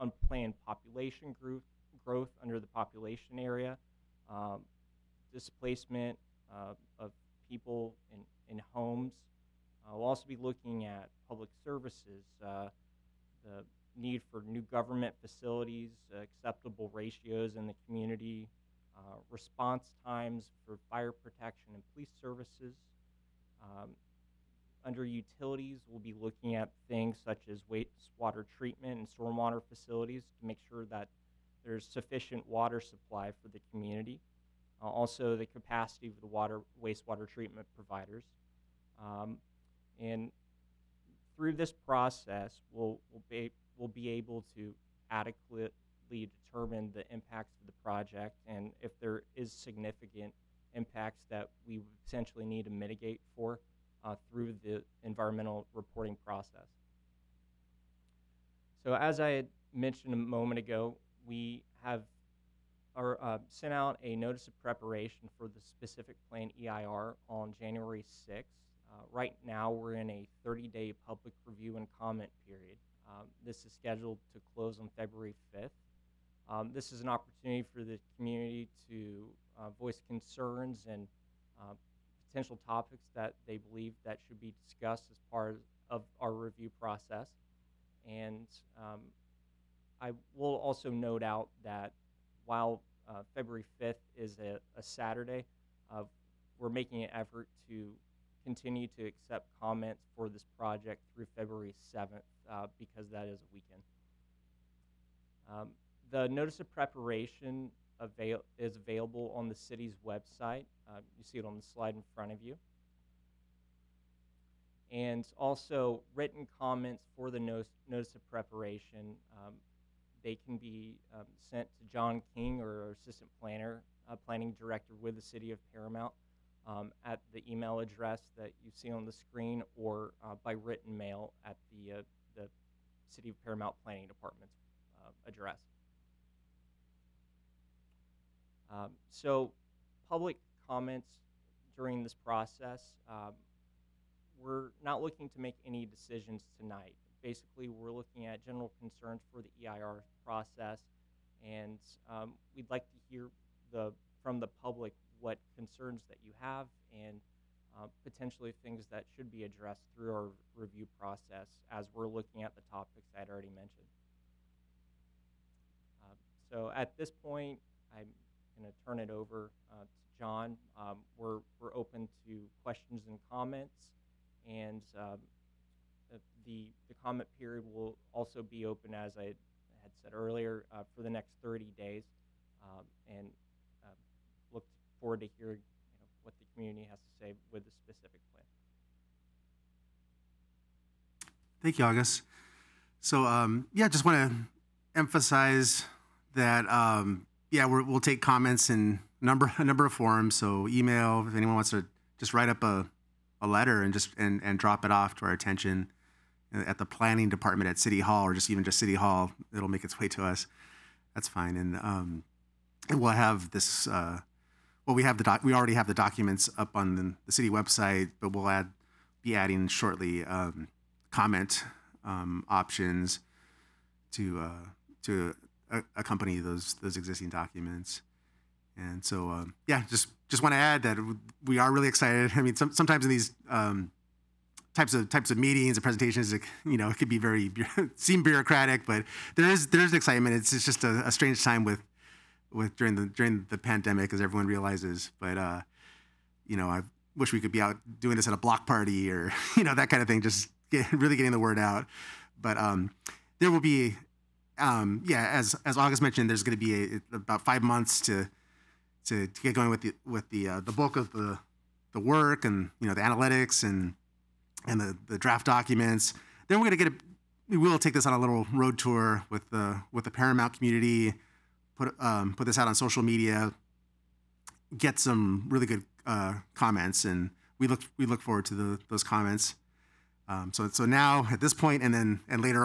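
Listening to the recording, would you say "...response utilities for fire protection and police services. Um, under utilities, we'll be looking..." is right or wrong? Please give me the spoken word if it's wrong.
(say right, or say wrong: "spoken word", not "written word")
wrong: "times", not "utilities".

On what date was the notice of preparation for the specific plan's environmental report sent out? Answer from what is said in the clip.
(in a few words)
January 6.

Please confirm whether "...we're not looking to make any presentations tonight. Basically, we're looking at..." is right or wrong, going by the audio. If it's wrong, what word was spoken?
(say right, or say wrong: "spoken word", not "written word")
wrong: "decisions", not "presentations".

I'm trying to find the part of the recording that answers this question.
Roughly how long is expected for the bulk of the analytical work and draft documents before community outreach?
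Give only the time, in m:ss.
4:17.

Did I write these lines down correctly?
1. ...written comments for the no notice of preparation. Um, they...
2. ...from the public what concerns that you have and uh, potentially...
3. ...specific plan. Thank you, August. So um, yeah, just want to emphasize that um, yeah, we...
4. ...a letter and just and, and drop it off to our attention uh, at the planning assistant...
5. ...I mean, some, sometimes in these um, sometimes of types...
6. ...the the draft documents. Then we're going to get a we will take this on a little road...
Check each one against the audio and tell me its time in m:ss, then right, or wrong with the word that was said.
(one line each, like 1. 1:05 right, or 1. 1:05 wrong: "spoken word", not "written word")
1. 1:56 right
2. 2:34 right
3. 3:07 right
4. 3:23 wrong: "department", not "assistant"
5. 3:52 wrong: "types", not "sometimes"
6. 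4:24 right.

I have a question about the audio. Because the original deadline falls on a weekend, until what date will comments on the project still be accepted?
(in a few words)
February 7.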